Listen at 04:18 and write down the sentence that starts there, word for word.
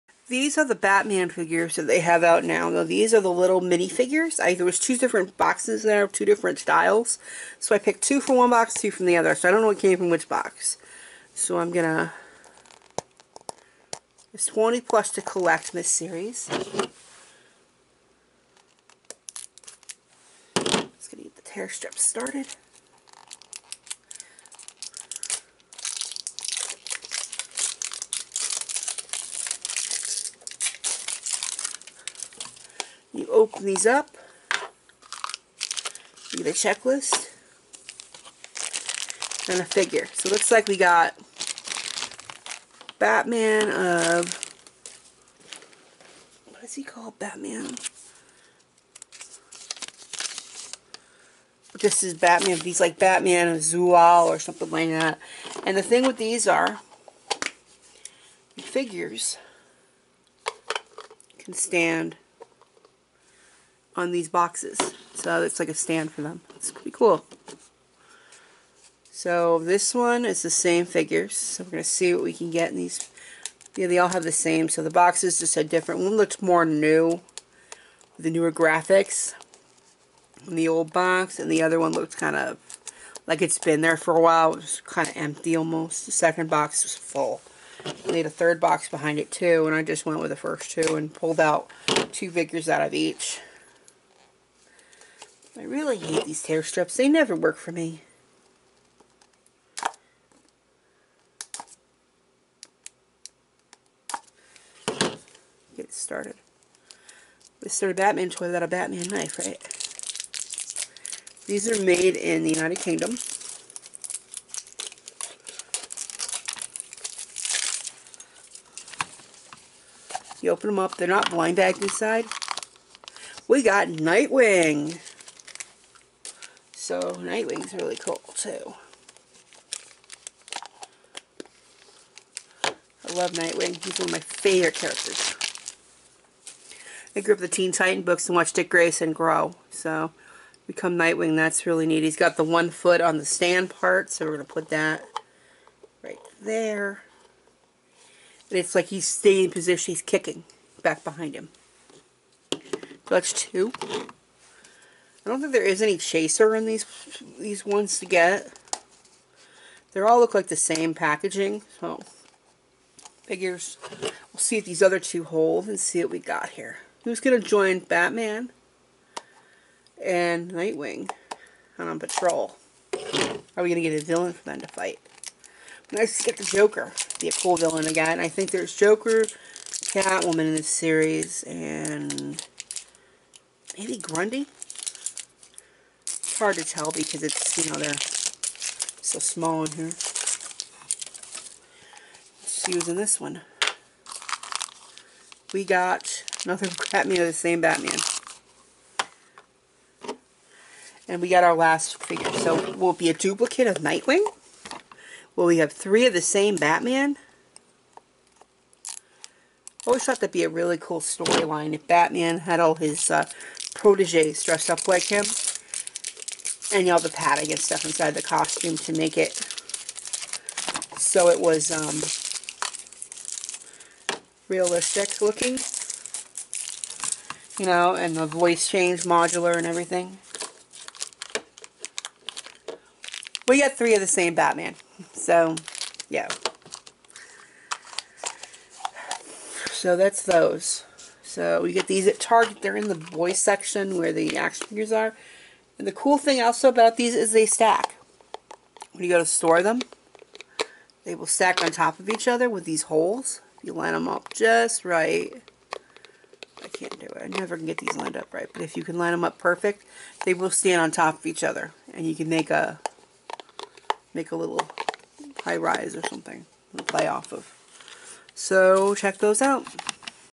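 But if you can line them up perfect, they will stand on top of each other.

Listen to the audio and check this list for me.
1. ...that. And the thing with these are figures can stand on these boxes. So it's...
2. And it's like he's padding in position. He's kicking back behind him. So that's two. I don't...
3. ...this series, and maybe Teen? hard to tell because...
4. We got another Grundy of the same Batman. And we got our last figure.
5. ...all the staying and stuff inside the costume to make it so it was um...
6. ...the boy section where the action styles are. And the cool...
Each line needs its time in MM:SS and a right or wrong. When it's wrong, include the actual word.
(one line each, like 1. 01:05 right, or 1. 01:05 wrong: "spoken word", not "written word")
1. 00:54 right
2. 02:28 wrong: "staying", not "padding"
3. 03:00 wrong: "Grundy", not "Teen"
4. 03:15 wrong: "Batman", not "Grundy"
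5. 03:36 wrong: "padding", not "staying"
6. 04:02 wrong: "figures", not "styles".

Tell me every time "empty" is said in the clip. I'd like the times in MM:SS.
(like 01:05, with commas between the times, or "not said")
01:25.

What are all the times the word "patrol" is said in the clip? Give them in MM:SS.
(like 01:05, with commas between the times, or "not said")
02:51.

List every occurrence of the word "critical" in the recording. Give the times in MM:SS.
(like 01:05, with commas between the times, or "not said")
not said.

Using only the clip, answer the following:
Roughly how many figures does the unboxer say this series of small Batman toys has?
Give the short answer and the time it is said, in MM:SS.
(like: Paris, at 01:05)
20 plus, at 00:14.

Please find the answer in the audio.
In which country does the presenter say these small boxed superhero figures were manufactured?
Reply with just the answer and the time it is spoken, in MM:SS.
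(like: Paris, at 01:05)
United Kingdom, at 01:52.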